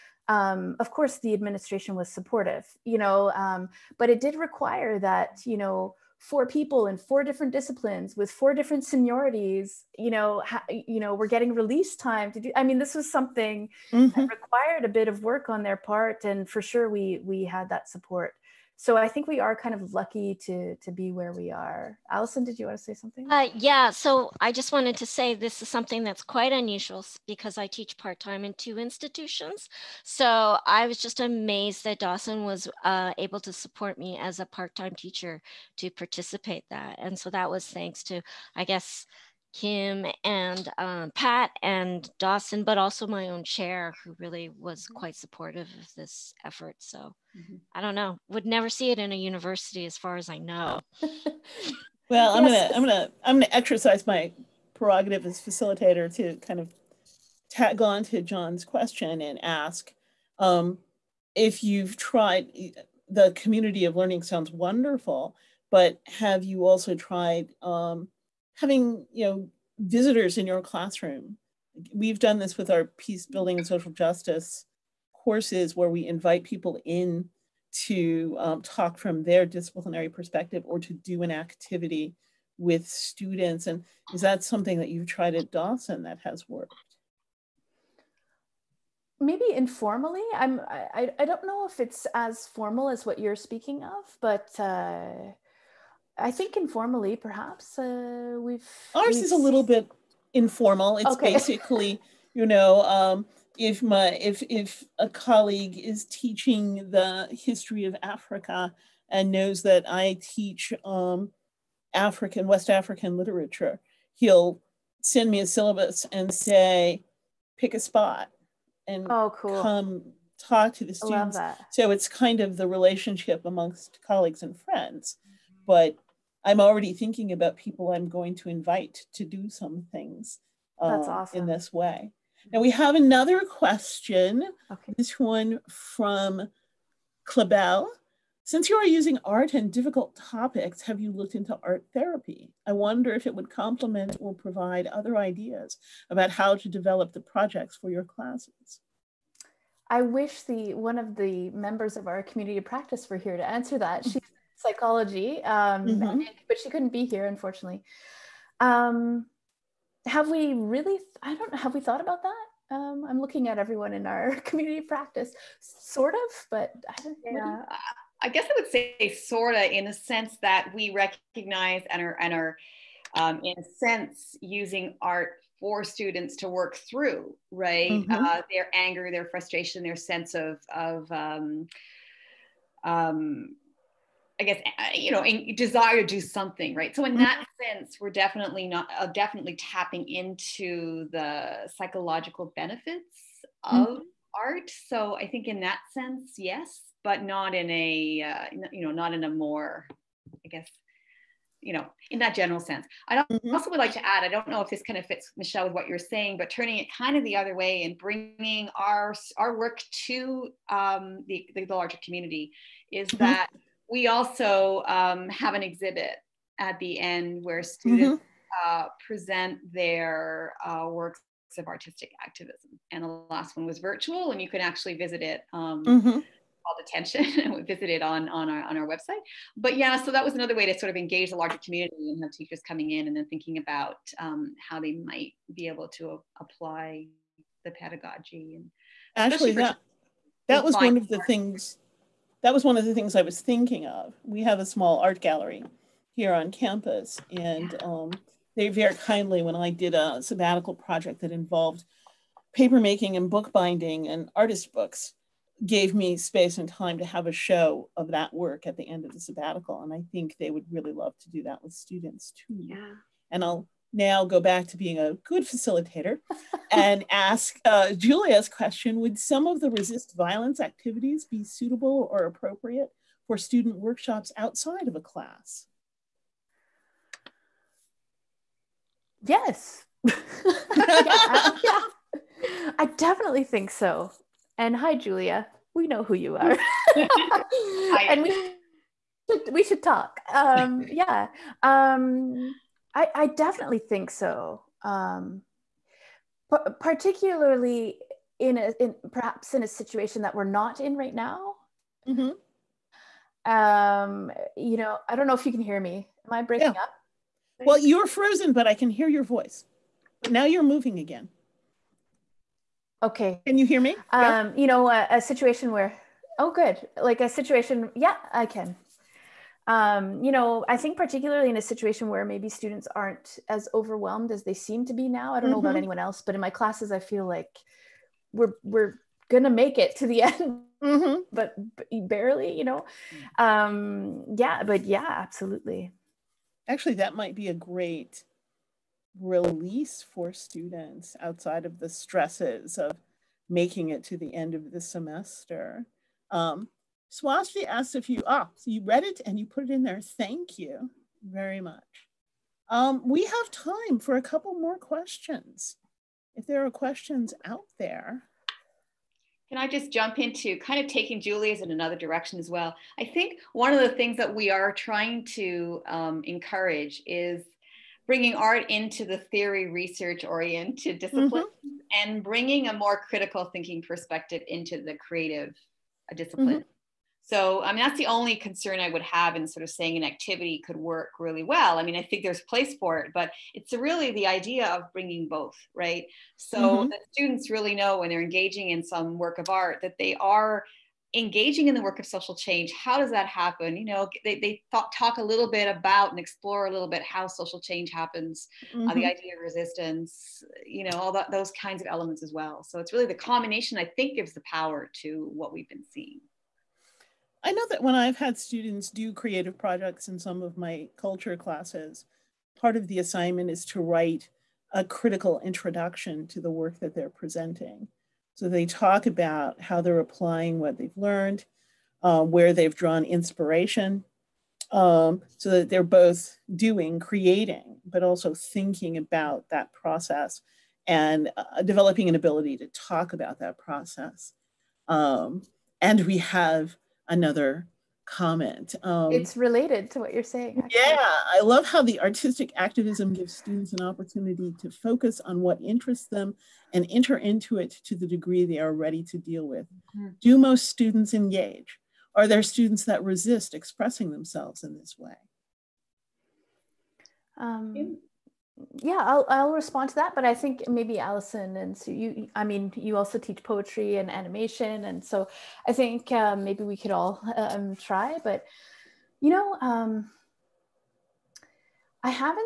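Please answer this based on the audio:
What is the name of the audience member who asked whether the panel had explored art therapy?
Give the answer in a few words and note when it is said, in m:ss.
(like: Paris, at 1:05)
Clabel, at 2:17.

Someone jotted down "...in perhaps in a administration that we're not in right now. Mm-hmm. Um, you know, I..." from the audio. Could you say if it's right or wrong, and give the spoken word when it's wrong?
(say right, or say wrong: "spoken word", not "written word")
wrong: "situation", not "administration".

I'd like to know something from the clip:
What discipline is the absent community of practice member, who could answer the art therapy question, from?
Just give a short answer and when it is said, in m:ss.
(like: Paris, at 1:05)
Psychology, at 2:34.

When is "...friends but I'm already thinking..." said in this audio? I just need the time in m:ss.
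2:04.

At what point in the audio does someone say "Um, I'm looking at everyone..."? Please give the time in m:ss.
2:42.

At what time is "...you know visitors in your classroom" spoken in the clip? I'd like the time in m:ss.
1:09.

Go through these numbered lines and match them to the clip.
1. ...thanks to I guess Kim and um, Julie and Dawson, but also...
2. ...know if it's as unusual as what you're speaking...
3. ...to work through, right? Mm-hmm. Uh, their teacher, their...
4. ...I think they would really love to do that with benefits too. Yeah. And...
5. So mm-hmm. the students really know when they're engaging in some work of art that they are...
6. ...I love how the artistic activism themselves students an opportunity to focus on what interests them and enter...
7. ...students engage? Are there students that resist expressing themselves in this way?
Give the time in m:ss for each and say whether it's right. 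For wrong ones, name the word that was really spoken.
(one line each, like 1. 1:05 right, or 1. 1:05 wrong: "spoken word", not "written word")
1. 0:37 wrong: "Pat", not "Julie"
2. 1:31 wrong: "formal", not "unusual"
3. 2:56 wrong: "anger", not "teacher"
4. 4:19 wrong: "students", not "benefits"
5. 6:26 right
6. 7:21 wrong: "gives", not "themselves"
7. 7:30 right.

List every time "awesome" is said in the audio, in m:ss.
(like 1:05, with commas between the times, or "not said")
2:11.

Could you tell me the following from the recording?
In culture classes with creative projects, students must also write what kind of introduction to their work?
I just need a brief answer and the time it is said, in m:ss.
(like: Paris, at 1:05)
A critical introduction, at 6:54.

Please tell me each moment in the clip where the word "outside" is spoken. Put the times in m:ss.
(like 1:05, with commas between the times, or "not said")
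4:34, 5:41.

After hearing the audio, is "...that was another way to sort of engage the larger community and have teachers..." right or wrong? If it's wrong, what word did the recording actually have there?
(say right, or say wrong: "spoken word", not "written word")
right.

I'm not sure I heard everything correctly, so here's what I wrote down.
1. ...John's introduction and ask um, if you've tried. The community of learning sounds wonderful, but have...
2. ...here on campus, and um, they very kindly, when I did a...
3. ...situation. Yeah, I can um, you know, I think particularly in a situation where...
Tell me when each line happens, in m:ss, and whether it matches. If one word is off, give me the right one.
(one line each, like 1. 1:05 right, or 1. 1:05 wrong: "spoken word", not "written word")
1. 0:58 wrong: "question", not "introduction"
2. 4:06 right
3. 5:17 right.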